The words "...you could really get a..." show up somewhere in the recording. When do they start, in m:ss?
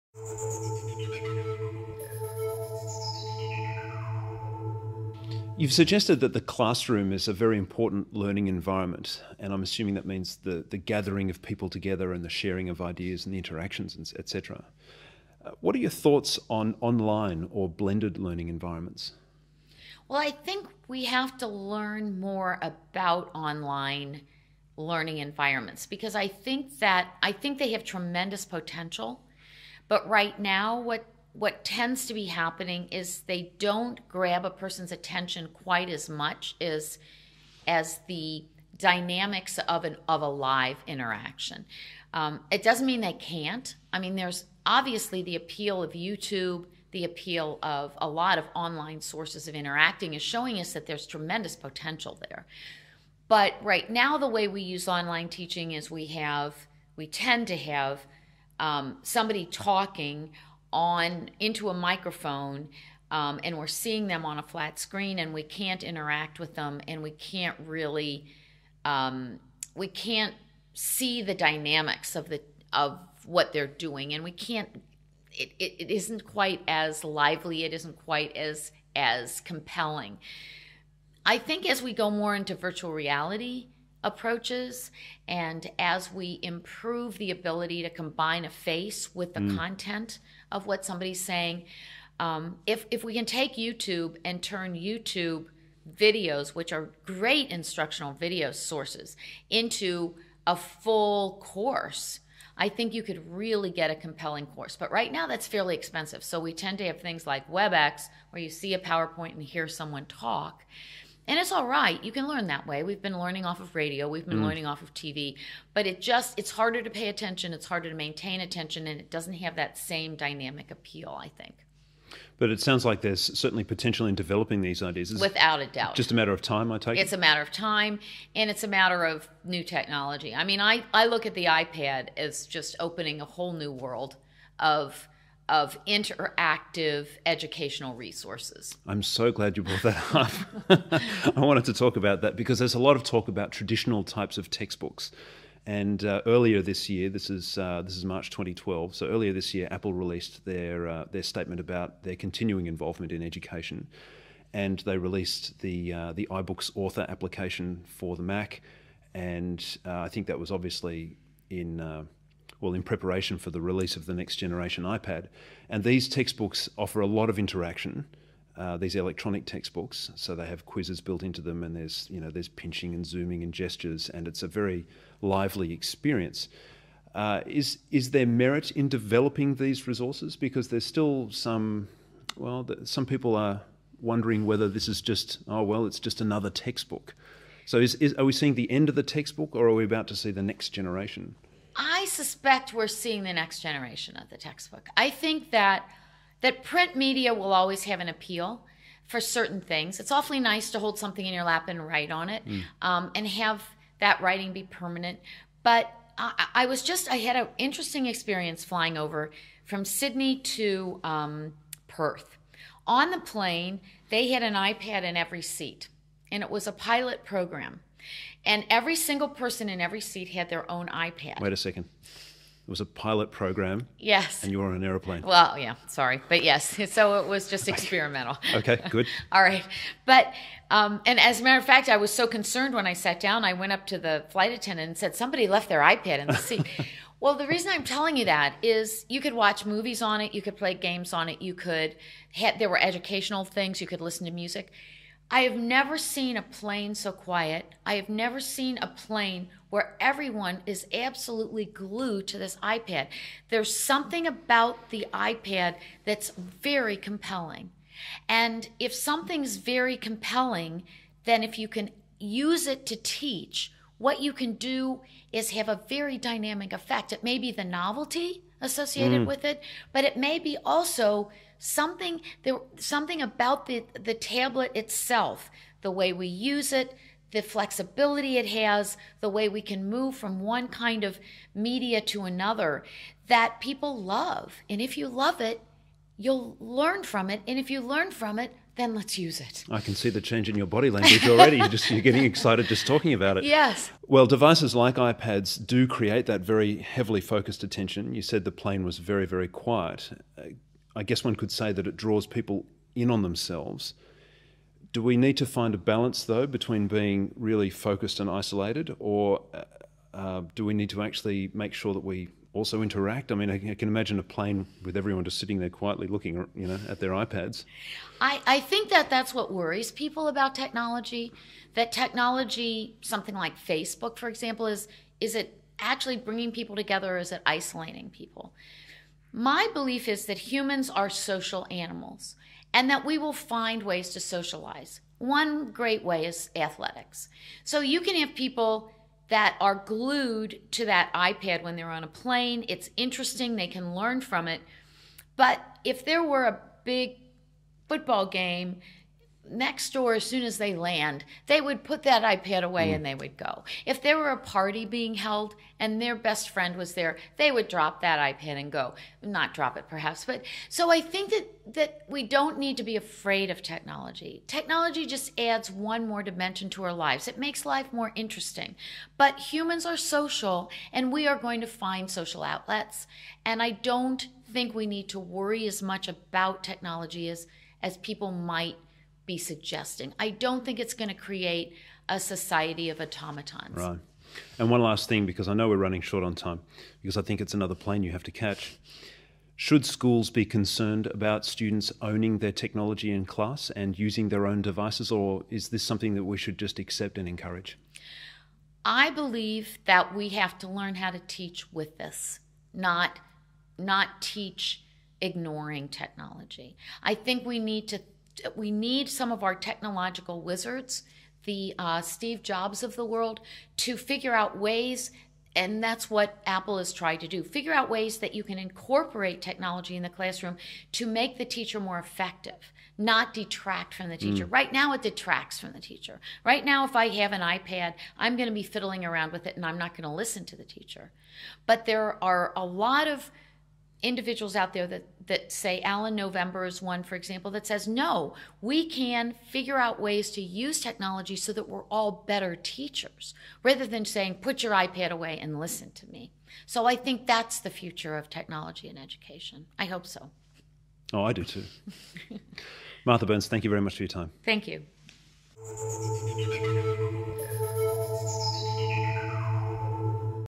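1:42.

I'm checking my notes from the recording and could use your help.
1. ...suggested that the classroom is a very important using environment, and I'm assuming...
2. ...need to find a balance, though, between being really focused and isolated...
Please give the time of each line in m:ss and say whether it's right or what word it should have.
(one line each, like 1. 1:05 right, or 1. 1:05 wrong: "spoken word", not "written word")
1. 0:05 wrong: "learning", not "using"
2. 5:05 right.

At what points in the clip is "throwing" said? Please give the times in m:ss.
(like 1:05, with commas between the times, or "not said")
not said.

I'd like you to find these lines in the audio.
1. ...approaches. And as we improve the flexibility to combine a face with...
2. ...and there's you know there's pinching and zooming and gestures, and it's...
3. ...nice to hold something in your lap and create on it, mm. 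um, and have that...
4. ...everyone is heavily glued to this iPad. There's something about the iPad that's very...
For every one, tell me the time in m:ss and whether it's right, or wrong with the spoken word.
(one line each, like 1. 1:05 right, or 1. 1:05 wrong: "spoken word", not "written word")
1. 1:24 wrong: "ability", not "flexibility"
2. 2:51 right
3. 3:20 wrong: "write", not "create"
4. 4:09 wrong: "absolutely", not "heavily".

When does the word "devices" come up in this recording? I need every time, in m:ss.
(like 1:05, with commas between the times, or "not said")
4:54, 6:34.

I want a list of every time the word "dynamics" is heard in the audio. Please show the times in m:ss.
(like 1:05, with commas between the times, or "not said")
0:38, 1:11, 2:00, 4:26.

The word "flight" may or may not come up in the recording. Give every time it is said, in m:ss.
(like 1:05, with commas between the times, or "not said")
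3:54.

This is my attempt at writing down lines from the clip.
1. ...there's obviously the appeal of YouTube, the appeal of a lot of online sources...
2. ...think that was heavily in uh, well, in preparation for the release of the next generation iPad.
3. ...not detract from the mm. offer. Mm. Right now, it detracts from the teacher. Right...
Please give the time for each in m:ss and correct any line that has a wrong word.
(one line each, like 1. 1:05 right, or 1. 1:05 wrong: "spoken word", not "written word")
1. 0:44 right
2. 2:40 wrong: "obviously", not "heavily"
3. 7:02 wrong: "teacher", not "offer".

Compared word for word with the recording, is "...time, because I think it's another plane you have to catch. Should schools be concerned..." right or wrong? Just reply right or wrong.
right.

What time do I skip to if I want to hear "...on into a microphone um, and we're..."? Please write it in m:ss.
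1:00.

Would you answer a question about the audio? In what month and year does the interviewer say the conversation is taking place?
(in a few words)
March 2012.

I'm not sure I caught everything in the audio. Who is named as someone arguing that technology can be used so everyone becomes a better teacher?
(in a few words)
Alan November.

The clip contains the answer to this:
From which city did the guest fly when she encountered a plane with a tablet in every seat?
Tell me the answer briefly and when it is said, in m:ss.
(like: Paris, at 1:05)
Sydney, at 3:29.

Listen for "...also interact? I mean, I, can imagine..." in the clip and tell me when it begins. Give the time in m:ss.
5:12.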